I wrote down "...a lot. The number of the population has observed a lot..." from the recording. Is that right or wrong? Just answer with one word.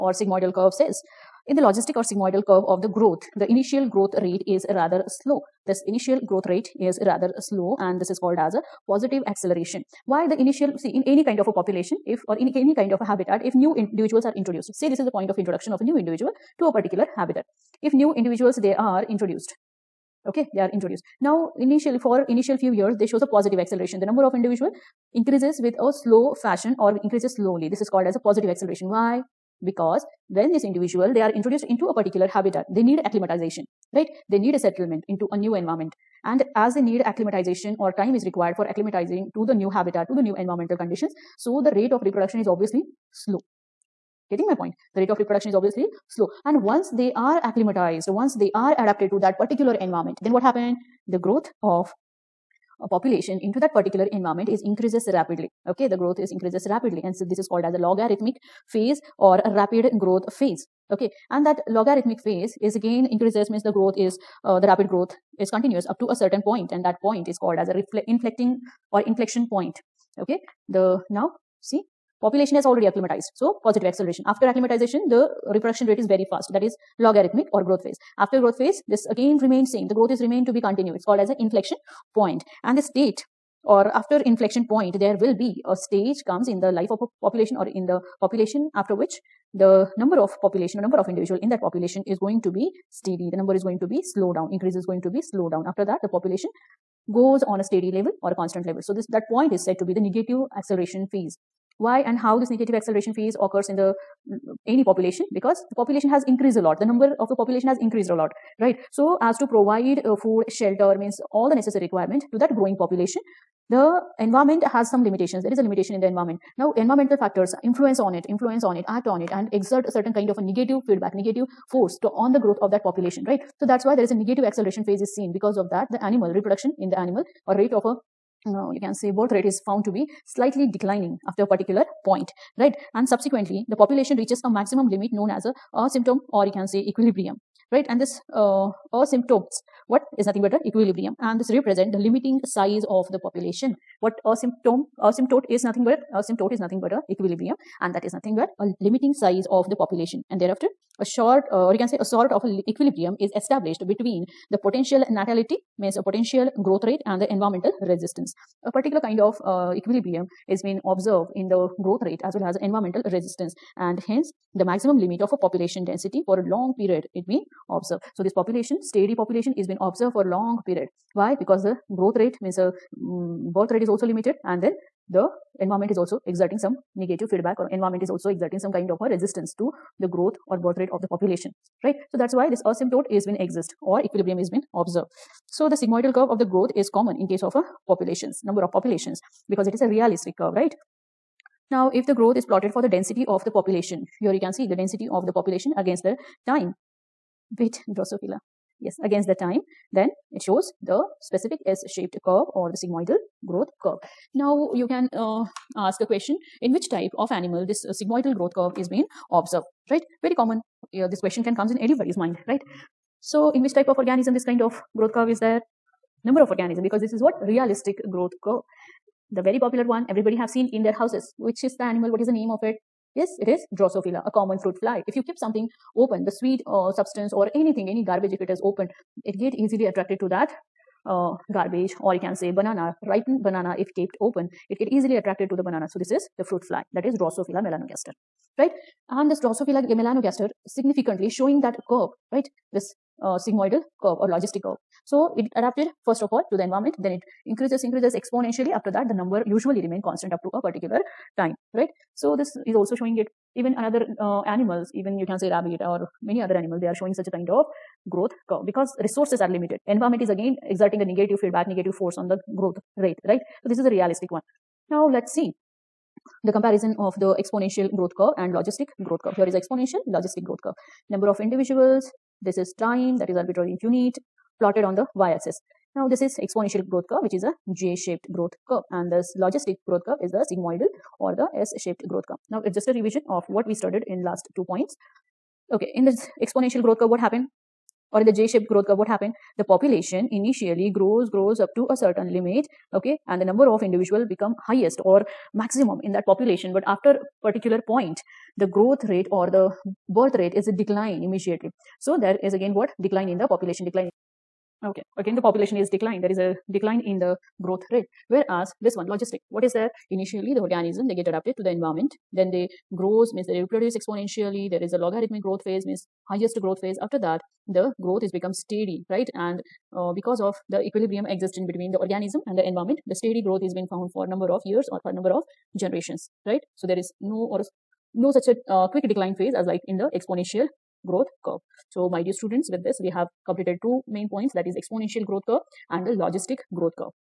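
wrong.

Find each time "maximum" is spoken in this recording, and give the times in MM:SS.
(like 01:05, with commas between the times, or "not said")
02:14, 02:44, 04:55.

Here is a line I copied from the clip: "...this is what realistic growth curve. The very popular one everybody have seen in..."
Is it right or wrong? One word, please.
right.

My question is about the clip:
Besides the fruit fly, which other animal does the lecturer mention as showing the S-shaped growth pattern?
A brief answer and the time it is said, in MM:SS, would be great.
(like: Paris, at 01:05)
rabbit, at 04:15.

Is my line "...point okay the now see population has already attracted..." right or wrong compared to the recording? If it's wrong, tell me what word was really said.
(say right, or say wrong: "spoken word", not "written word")
wrong: "acclimatized", not "attracted".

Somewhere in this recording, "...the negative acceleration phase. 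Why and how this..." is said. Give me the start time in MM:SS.
01:39.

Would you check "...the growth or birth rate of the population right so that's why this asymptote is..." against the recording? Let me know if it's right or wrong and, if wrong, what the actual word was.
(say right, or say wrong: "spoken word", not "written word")
right.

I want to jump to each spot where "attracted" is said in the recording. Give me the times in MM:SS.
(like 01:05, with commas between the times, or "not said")
03:49, 03:55.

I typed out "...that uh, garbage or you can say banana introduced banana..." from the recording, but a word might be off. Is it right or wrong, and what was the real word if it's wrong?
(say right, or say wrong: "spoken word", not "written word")
wrong: "ripened", not "introduced".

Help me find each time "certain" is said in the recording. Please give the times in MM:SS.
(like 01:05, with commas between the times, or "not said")
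01:06, 01:59, 04:51.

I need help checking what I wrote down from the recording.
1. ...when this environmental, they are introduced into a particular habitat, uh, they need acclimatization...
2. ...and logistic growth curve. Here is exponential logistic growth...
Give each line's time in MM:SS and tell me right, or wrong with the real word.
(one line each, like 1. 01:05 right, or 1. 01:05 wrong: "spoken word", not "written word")
1. 00:30 wrong: "individual", not "environmental"
2. 04:28 right.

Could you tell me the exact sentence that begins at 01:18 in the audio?
After growth phase, this again remains same.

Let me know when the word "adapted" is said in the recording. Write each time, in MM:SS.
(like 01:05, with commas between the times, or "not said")
00:48, 04:05, 05:11.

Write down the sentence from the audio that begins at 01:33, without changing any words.
The number is going to be slow down.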